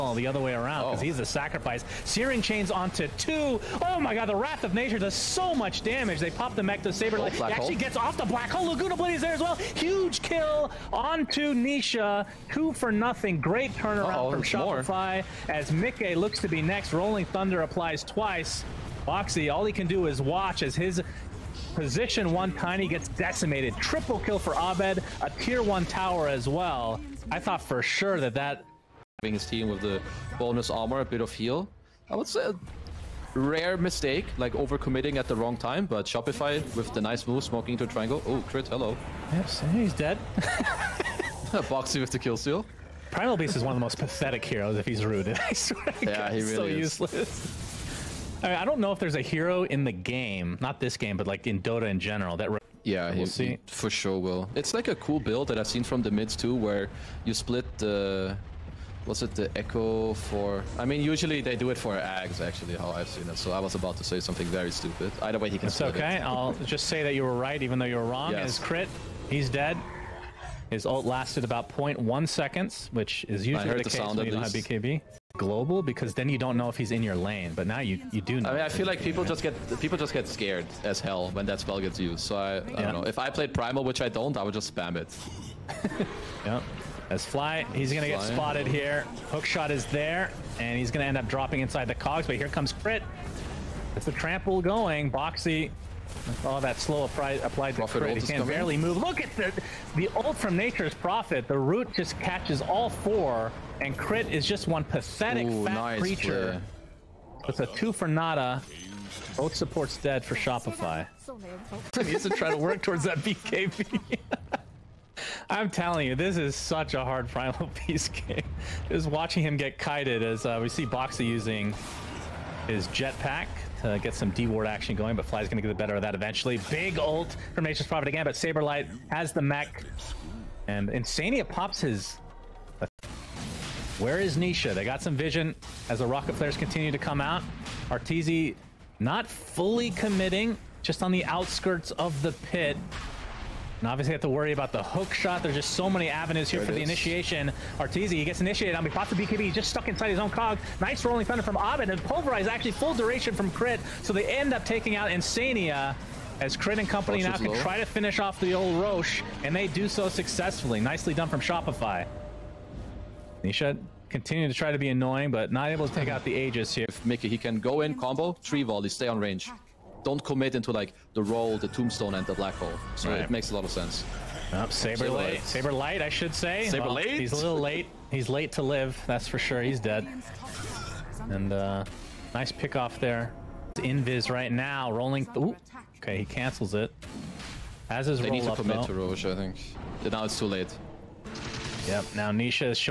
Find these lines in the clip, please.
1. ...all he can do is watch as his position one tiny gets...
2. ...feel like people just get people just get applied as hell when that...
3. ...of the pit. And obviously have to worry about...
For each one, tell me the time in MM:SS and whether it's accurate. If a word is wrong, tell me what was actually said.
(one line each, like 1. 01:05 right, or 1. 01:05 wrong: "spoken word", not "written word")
1. 00:19 right
2. 01:18 wrong: "scared", not "applied"
3. 02:21 right.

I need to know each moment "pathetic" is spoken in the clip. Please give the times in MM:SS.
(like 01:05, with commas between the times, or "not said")
00:43, 01:44.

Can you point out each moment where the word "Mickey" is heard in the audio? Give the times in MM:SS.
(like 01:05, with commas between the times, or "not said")
00:15, 02:47.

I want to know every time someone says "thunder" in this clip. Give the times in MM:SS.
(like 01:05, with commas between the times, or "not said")
00:17, 02:31.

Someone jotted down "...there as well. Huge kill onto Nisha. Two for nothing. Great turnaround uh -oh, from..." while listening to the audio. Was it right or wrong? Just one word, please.
right.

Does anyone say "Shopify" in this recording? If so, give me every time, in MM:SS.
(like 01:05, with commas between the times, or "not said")
00:14, 00:36, 01:50, 02:41.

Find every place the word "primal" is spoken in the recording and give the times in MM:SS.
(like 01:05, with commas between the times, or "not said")
00:43, 01:23, 01:57.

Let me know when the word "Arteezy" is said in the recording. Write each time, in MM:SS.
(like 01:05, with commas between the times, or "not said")
02:17, 02:27.